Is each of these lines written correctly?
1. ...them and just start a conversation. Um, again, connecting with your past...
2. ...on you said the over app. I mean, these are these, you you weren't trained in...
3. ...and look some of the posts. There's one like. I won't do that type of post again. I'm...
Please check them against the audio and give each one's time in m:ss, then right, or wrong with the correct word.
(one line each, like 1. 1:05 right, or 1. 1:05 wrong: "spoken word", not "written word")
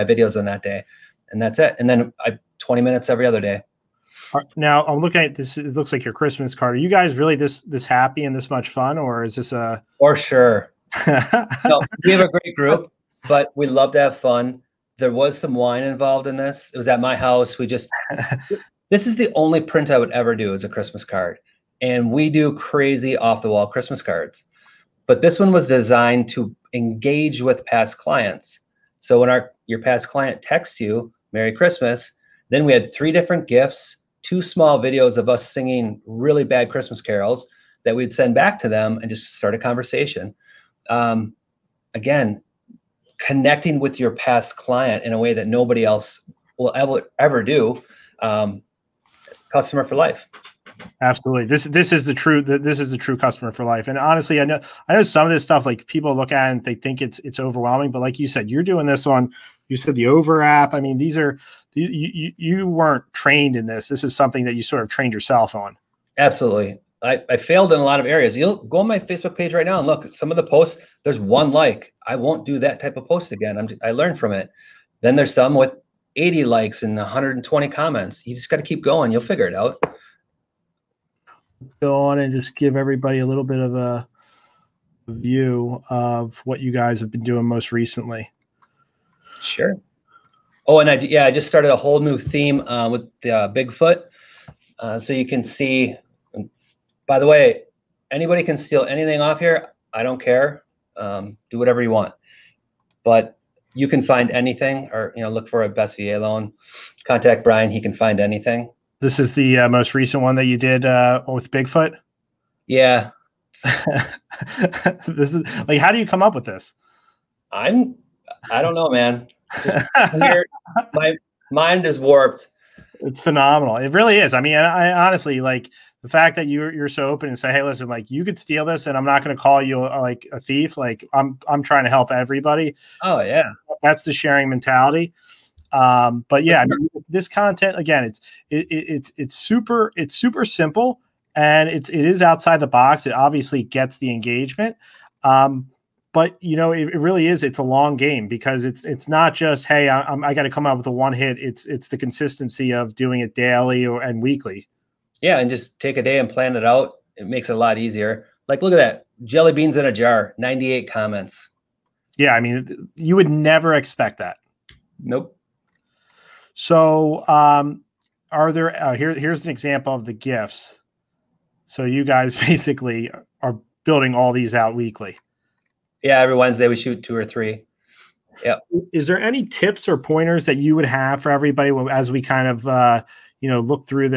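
1. 0:38 right
2. 0:59 right
3. 1:09 right.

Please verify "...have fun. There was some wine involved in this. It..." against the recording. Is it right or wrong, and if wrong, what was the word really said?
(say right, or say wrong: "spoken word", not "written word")
right.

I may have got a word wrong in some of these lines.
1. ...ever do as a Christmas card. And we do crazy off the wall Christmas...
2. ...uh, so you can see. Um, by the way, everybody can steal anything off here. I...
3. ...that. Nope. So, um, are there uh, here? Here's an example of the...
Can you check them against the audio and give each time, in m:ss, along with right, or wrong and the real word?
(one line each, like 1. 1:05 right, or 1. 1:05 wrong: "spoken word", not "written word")
1. 0:20 right
2. 1:34 wrong: "anybody", not "everybody"
3. 2:44 right.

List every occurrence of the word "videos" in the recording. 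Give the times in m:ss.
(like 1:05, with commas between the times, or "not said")
0:00, 0:34.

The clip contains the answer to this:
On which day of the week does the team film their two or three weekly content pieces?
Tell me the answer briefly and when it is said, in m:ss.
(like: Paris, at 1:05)
Wednesday, at 2:56.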